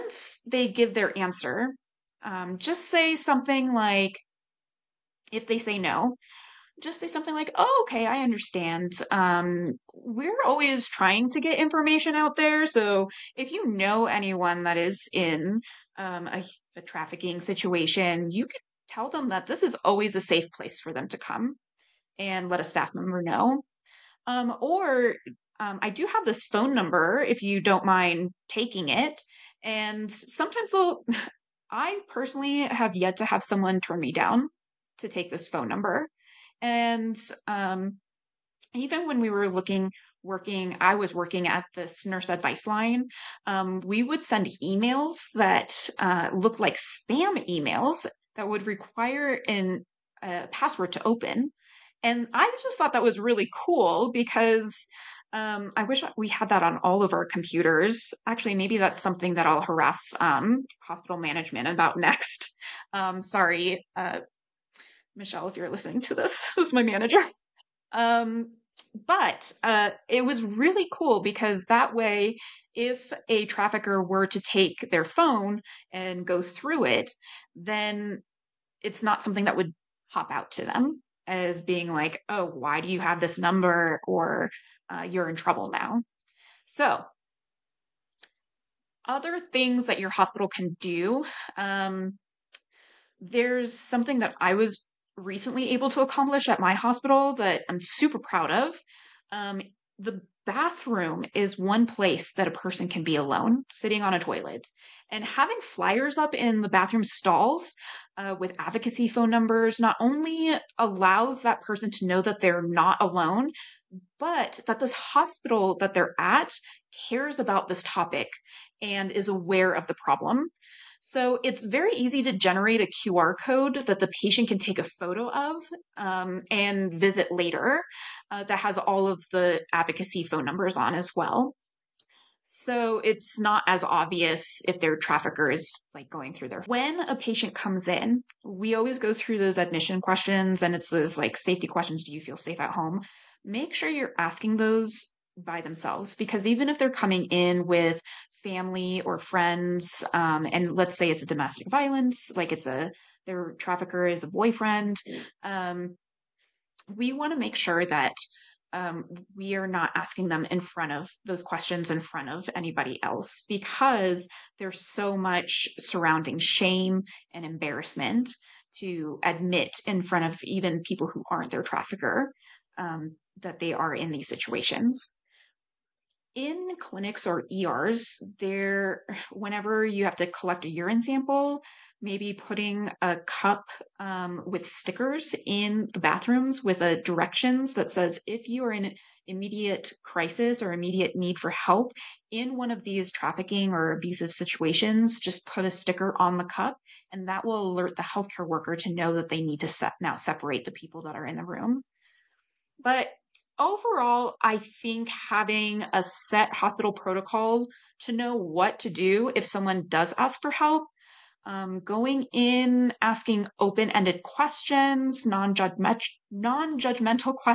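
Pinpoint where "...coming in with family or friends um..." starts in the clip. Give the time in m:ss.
2:26.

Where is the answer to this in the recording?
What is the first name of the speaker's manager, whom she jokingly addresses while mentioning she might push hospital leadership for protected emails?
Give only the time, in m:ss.
1:05.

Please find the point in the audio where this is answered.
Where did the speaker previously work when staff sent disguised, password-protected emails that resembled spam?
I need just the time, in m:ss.
0:42.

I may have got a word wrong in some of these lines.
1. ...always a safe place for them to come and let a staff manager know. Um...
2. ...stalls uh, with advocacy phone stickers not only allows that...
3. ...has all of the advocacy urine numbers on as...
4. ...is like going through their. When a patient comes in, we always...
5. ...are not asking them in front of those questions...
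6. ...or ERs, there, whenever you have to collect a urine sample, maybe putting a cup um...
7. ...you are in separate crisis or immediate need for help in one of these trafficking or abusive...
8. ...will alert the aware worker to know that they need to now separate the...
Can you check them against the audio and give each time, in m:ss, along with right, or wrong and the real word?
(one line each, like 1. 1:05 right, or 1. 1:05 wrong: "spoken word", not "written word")
1. 0:19 wrong: "member", not "manager"
2. 1:47 wrong: "numbers", not "stickers"
3. 2:08 wrong: "phone", not "urine"
4. 2:15 right
5. 2:39 right
6. 2:57 right
7. 3:08 wrong: "immediate", not "separate"
8. 3:17 wrong: "healthcare", not "aware".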